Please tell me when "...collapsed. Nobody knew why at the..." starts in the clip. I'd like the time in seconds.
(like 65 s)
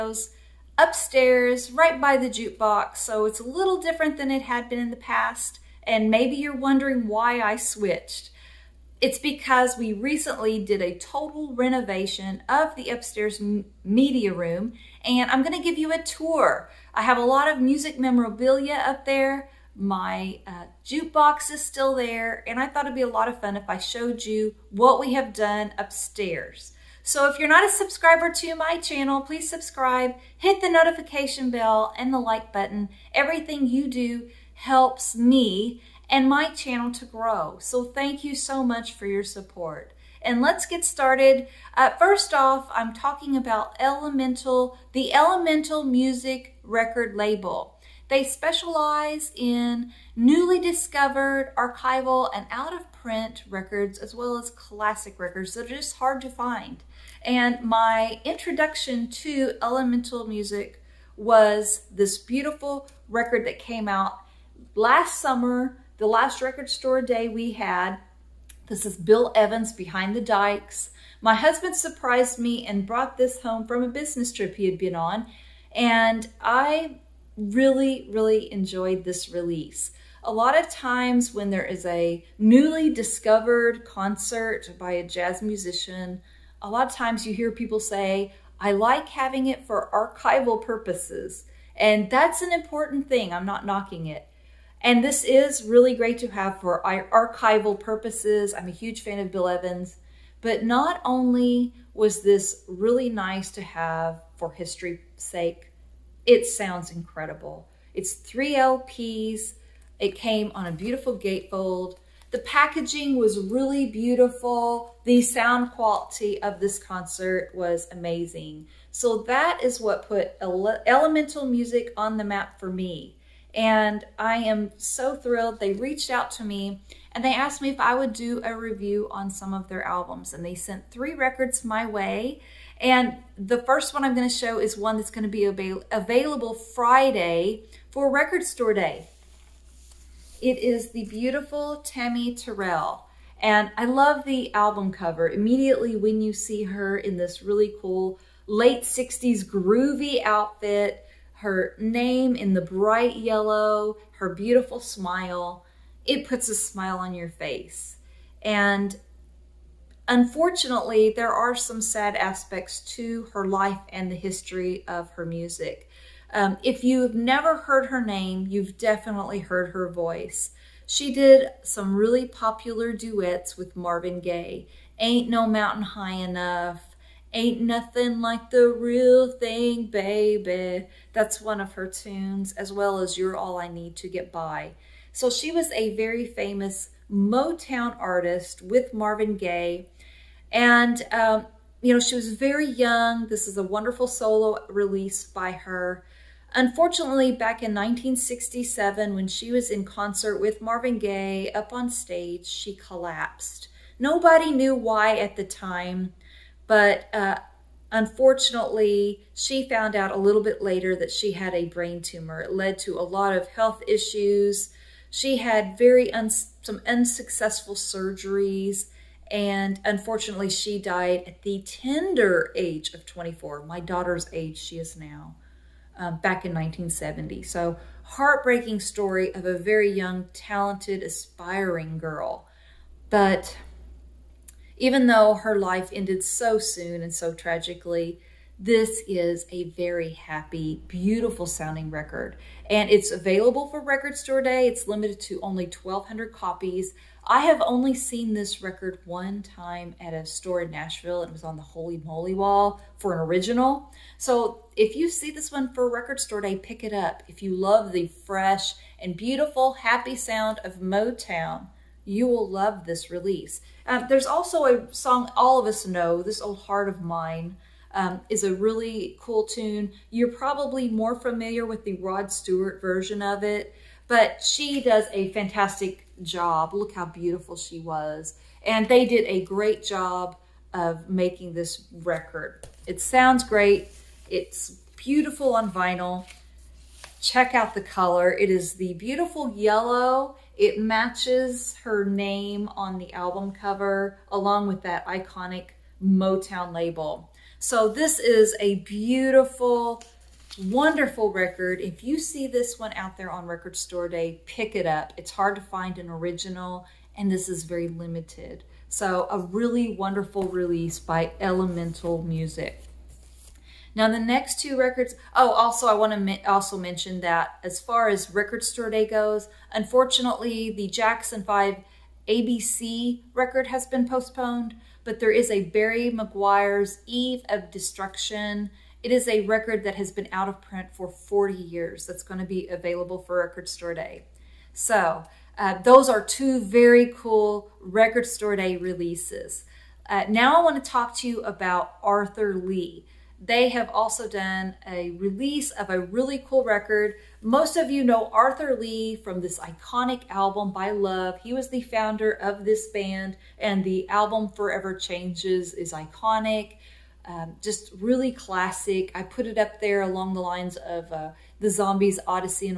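202 s.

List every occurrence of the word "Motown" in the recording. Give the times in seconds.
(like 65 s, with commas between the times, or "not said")
187 s, 260 s, 296 s.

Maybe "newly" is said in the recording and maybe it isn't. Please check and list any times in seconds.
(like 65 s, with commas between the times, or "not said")
50 s, 82 s.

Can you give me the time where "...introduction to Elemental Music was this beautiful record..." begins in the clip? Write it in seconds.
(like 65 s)
58 s.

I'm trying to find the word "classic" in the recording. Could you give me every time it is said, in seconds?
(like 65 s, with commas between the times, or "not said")
54 s, 358 s.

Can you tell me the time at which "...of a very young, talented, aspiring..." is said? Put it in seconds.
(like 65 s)
229 s.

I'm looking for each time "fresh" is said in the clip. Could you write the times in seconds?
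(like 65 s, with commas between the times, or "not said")
258 s.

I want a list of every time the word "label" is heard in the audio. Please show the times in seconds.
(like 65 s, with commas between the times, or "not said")
47 s, 296 s.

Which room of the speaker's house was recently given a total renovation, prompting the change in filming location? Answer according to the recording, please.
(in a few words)
Upstairs media room.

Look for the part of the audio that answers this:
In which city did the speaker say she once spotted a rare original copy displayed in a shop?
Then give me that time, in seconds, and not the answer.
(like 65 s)
250 s.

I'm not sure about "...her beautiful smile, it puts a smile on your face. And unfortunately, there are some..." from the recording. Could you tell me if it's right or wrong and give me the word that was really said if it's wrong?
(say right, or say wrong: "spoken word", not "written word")
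right.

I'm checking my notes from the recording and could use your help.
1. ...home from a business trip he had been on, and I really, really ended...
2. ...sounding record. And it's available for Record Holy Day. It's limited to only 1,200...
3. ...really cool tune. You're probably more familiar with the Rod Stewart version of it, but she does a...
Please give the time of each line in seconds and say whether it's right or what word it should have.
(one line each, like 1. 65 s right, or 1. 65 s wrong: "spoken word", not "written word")
1. 73 s wrong: "enjoyed", not "ended"
2. 241 s wrong: "Store", not "Holy"
3. 268 s right.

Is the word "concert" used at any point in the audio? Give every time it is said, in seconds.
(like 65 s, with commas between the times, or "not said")
83 s, 116 s, 199 s.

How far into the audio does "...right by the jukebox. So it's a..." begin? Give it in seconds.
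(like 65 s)
1 s.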